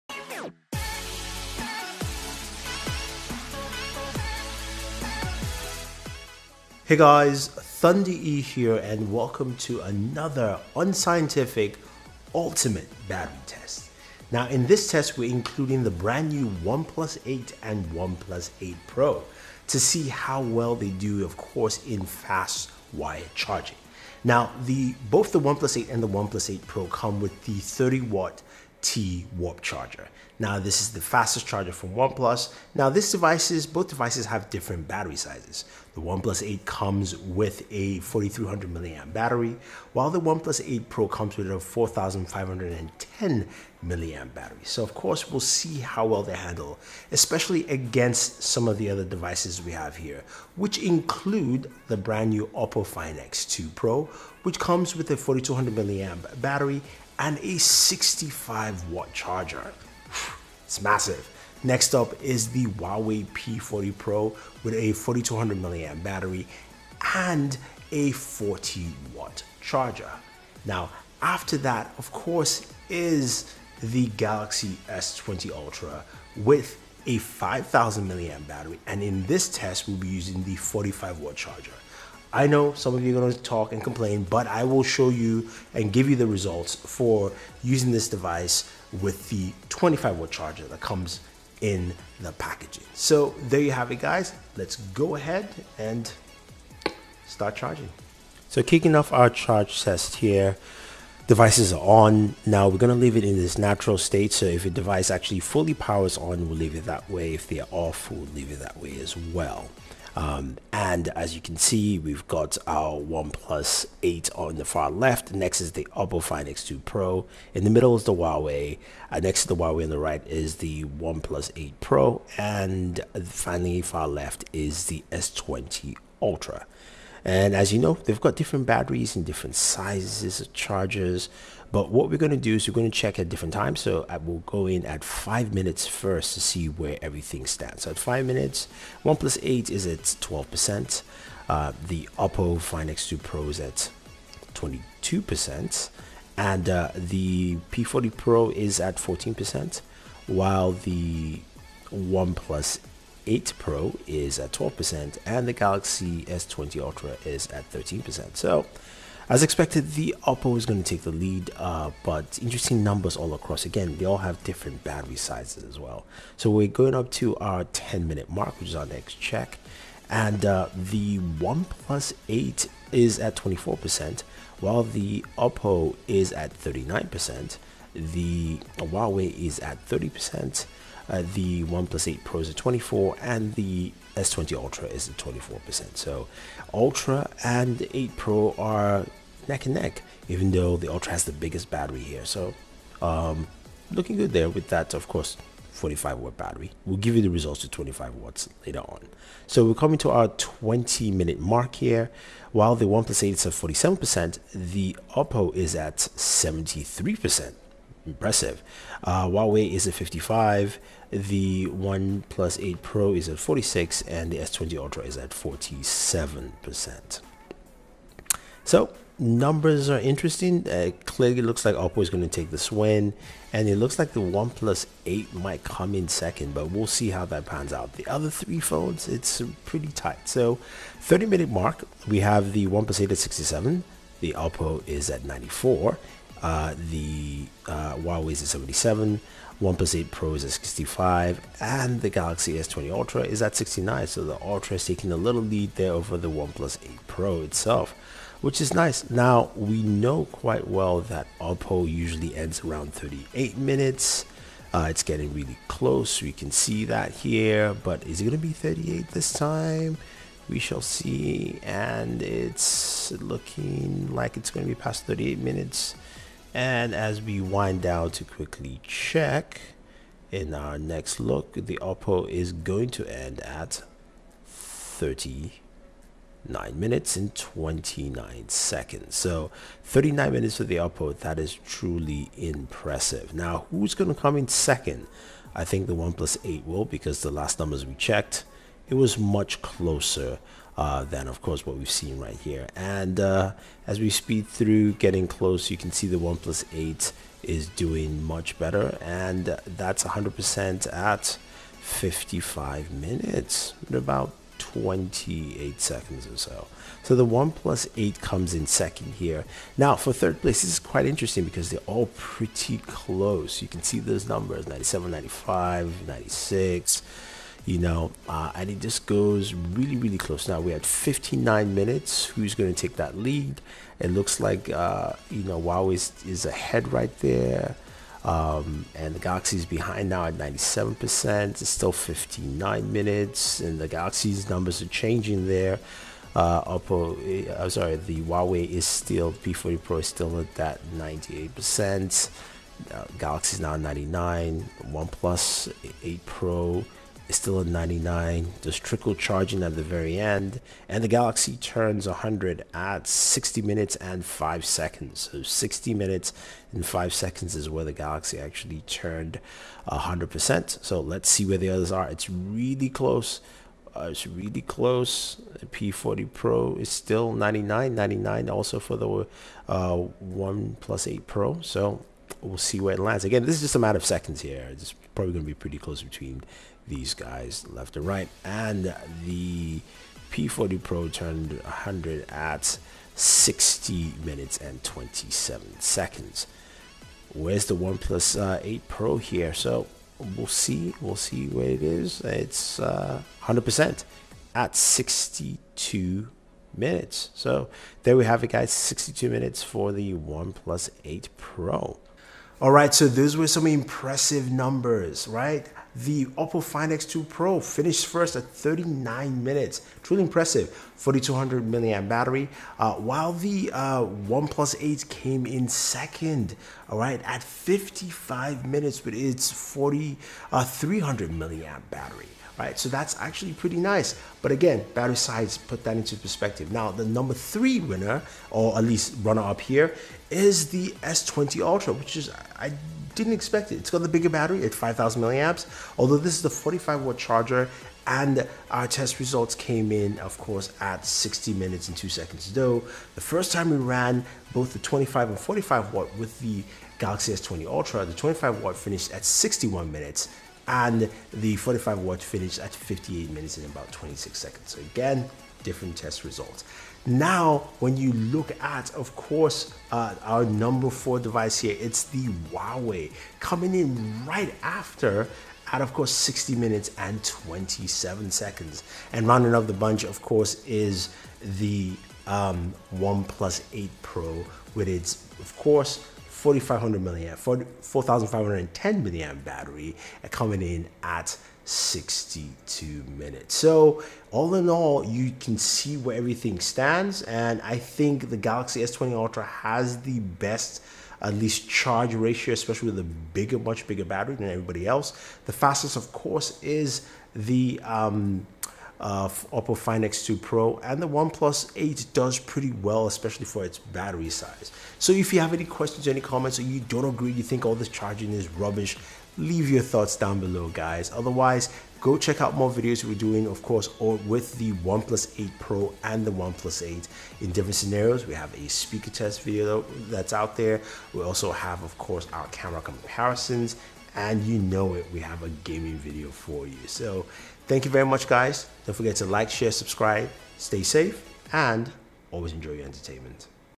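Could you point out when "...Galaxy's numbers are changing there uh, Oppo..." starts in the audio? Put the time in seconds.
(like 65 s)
333 s.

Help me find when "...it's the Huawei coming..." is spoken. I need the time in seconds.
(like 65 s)
461 s.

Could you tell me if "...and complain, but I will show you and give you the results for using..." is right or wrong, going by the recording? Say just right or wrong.
right.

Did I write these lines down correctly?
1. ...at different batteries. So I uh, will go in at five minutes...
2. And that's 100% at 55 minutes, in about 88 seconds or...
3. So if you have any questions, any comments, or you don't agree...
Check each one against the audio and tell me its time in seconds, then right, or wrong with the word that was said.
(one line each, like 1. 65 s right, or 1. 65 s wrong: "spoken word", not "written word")
1. 133 s wrong: "times", not "batteries"
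2. 299 s wrong: "28", not "88"
3. 504 s right.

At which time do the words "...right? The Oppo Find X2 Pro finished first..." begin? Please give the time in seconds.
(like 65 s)
405 s.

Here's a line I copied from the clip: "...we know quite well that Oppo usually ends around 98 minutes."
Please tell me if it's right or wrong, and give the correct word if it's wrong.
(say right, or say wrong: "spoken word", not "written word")
wrong: "38", not "98".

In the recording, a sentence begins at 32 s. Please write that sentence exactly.
Now these devices, both devices have different battery sizes.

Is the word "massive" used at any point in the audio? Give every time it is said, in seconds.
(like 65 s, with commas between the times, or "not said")
60 s.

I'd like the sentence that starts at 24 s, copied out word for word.
Now, the both the OnePlus 8 and the OnePlus 8 Pro come with the 30 watt T Warp charger.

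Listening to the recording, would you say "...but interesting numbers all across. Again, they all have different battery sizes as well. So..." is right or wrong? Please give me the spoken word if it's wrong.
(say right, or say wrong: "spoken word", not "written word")
right.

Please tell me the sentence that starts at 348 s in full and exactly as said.
There's trickle charging at the very end.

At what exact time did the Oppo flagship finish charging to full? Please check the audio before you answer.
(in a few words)
39 minutes 29 seconds.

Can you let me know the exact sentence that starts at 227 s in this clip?
The other three phones, it's pretty tight.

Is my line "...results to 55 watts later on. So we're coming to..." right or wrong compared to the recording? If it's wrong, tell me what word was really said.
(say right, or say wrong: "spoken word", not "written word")
wrong: "25", not "55".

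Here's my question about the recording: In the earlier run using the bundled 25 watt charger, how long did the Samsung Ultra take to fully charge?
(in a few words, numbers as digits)
61 minutes.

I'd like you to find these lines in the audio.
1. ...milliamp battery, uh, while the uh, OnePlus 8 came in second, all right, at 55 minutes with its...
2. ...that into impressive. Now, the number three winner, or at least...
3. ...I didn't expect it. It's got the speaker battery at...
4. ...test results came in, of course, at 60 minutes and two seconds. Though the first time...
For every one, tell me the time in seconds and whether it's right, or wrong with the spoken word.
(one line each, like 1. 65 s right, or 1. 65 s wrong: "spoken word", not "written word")
1. 411 s right
2. 425 s wrong: "perspective", not "impressive"
3. 432 s wrong: "bigger", not "speaker"
4. 438 s right.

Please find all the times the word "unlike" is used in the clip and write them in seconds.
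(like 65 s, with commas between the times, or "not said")
not said.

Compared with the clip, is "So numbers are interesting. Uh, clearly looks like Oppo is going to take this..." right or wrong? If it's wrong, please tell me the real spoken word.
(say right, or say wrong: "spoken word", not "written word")
right.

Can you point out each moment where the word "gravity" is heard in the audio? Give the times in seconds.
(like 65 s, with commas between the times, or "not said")
not said.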